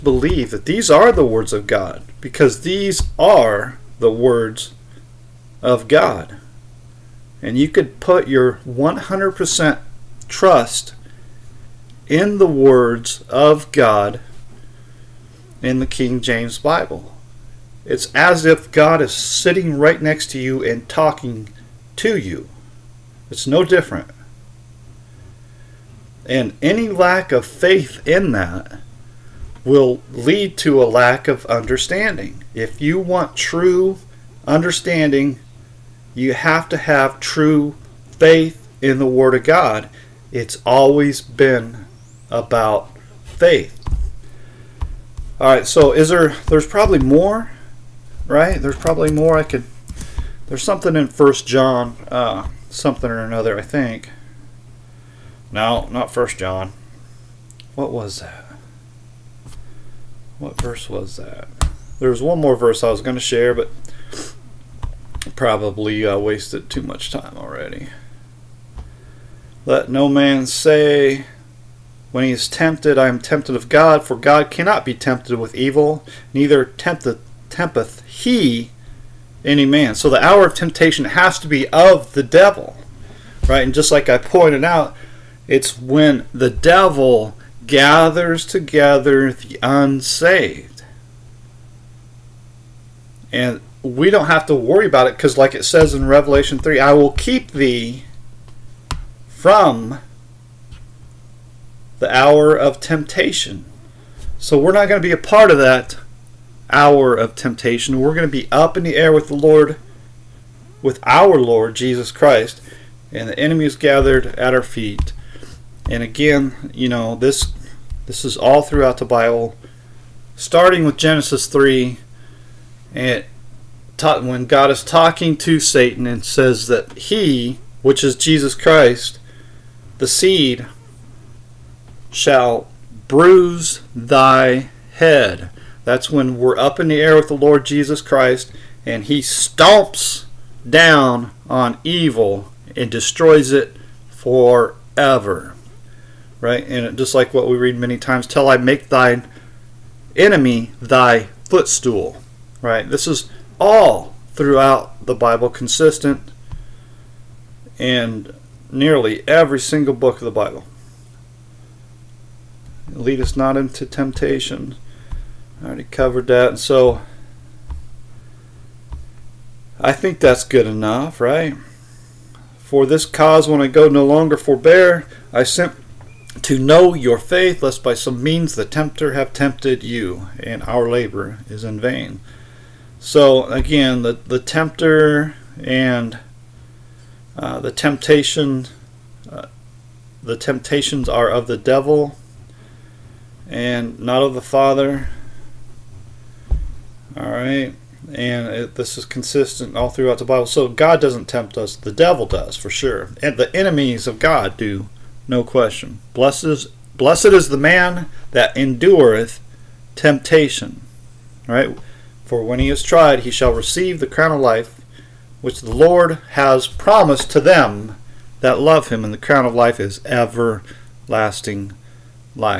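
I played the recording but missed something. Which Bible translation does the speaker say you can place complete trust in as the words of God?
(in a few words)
King James Bible.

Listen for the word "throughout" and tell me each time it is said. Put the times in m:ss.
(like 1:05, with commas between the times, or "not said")
1:58, 2:34, 3:19.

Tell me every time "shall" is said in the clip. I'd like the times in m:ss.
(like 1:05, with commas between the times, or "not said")
2:12, 3:33.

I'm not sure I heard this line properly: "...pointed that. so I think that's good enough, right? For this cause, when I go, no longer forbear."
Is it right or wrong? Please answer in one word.
wrong.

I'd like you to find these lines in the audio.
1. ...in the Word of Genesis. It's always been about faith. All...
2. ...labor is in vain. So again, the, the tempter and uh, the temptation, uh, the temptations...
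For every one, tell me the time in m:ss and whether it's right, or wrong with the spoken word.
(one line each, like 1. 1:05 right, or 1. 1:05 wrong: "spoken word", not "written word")
1. 0:38 wrong: "God", not "Genesis"
2. 3:00 right.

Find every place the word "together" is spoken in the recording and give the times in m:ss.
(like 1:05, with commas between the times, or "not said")
1:28.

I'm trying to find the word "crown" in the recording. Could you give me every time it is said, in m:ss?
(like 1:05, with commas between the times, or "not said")
3:34, 3:39.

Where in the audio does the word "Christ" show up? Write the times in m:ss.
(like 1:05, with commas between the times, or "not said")
1:52, 2:08, 2:18.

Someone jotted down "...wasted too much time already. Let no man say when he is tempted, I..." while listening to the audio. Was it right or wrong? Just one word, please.
right.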